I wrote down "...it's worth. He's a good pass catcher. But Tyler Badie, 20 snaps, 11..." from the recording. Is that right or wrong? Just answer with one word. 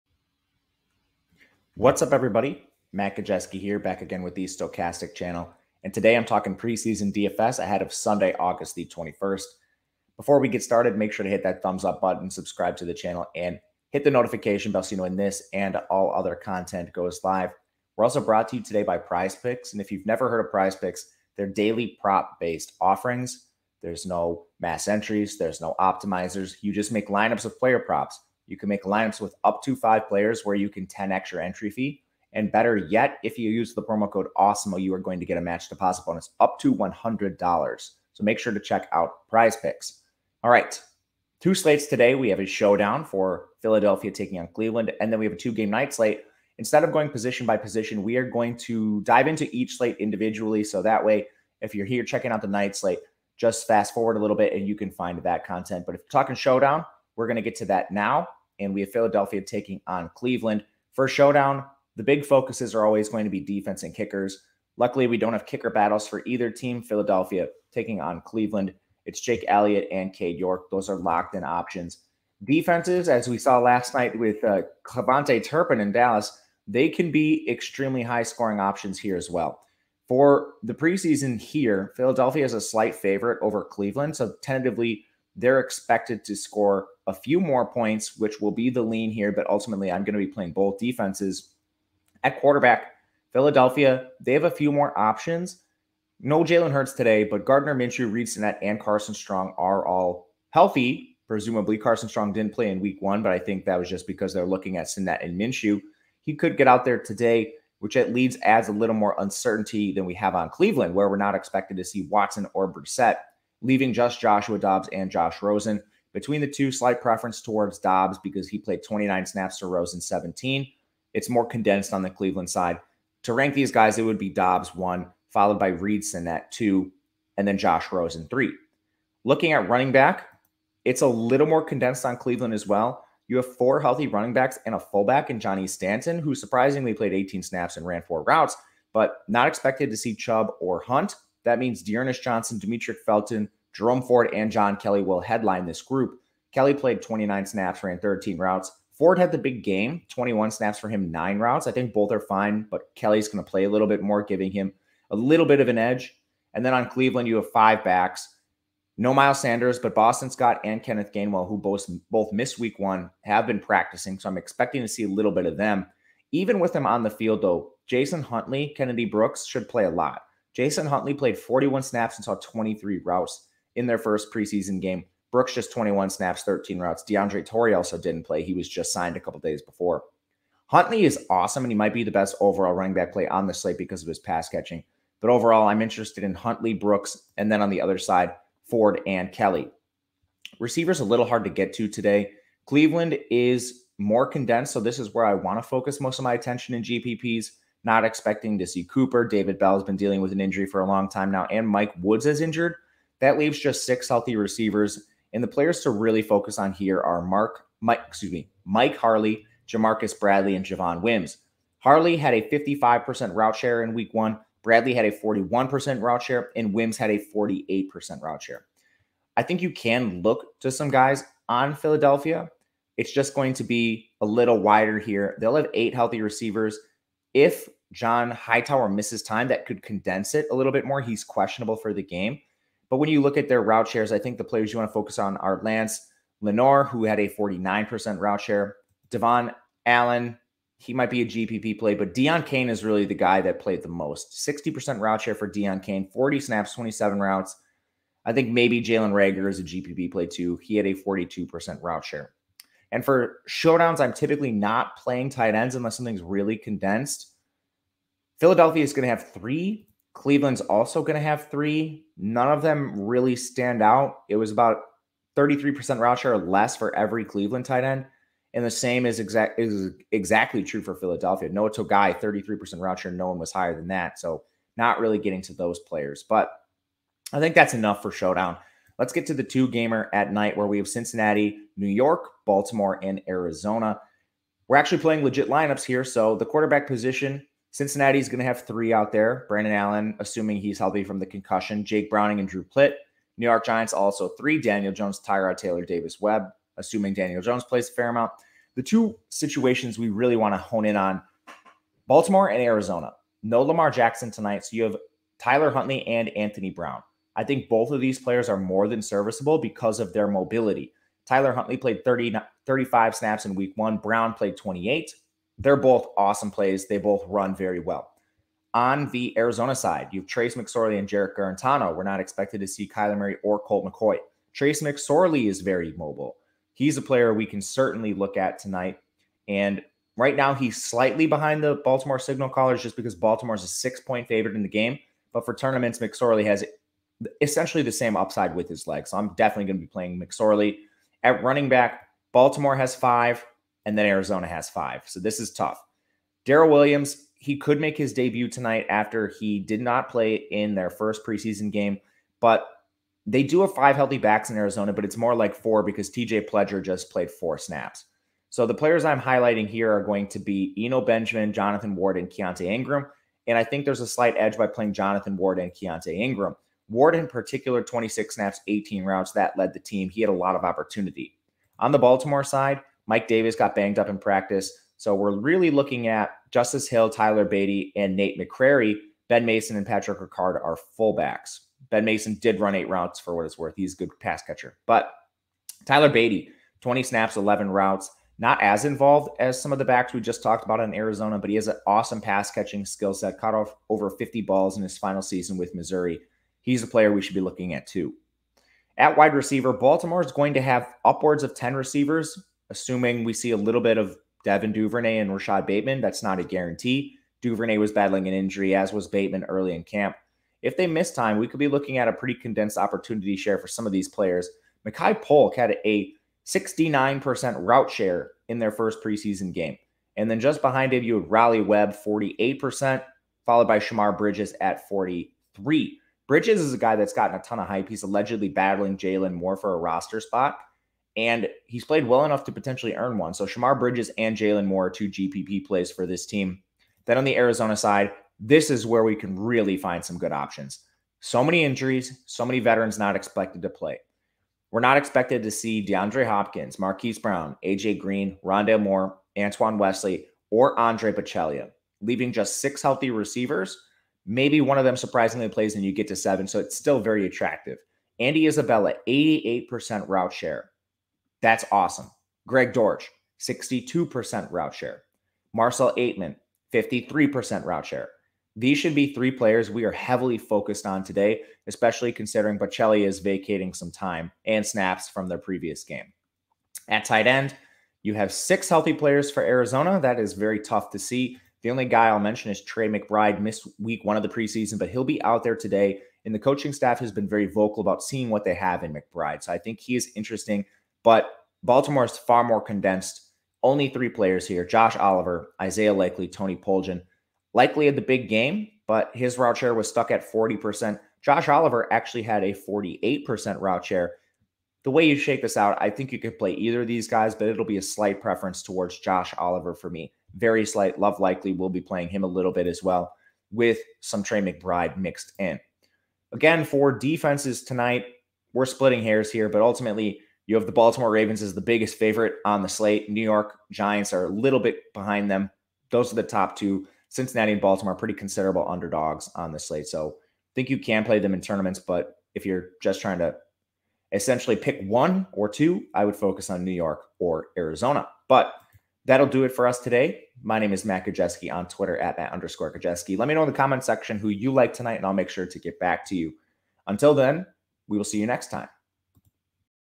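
right.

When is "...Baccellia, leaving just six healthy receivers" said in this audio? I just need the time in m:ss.
7:31.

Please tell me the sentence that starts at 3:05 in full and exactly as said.
But overall, I'm interested in Huntley, Brooks, and then on the other side, Ford and Kelly.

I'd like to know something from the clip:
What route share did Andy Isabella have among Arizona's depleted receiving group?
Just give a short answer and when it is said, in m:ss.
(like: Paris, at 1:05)
88%, at 7:39.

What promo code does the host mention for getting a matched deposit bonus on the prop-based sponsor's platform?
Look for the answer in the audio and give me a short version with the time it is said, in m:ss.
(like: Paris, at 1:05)
AWESEMO, at 0:34.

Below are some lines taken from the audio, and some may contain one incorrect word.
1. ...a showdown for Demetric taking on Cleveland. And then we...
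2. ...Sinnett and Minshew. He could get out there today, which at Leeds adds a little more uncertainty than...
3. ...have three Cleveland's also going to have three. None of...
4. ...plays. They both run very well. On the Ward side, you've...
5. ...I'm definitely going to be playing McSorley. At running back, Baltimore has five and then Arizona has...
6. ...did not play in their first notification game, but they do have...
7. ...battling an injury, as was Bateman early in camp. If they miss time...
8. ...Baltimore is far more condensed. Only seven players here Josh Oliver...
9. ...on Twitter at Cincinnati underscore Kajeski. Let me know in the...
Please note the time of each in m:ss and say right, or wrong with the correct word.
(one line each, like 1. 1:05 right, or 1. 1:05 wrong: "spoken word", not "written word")
1. 0:42 wrong: "Philadelphia", not "Demetric"
2. 1:44 right
3. 4:19 right
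4. 5:16 wrong: "Arizona", not "Ward"
5. 5:39 right
6. 5:49 wrong: "preseason", not "notification"
7. 6:47 right
8. 8:11 wrong: "three", not "seven"
9. 9:01 wrong: "Matt", not "Cincinnati".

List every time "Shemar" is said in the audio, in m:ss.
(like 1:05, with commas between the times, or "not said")
7:03, 7:13.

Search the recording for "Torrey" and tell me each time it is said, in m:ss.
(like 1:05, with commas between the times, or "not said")
2:57.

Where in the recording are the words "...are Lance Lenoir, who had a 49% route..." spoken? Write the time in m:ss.
3:55.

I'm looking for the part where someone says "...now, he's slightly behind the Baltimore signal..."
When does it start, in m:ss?
5:30.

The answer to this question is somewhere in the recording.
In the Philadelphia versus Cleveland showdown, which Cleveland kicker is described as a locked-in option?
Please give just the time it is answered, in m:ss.
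1:10.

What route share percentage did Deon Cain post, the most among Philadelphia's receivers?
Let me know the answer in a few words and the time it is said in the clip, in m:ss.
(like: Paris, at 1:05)
60%, at 4:04.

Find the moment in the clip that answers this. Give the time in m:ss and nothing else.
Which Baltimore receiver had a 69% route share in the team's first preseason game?
6:54.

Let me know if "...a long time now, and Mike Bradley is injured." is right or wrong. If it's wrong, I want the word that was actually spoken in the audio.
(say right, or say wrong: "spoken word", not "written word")
wrong: "Woods", not "Bradley".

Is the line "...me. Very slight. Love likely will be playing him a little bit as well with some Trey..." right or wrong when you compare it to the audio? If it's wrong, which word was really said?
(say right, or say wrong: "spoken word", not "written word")
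right.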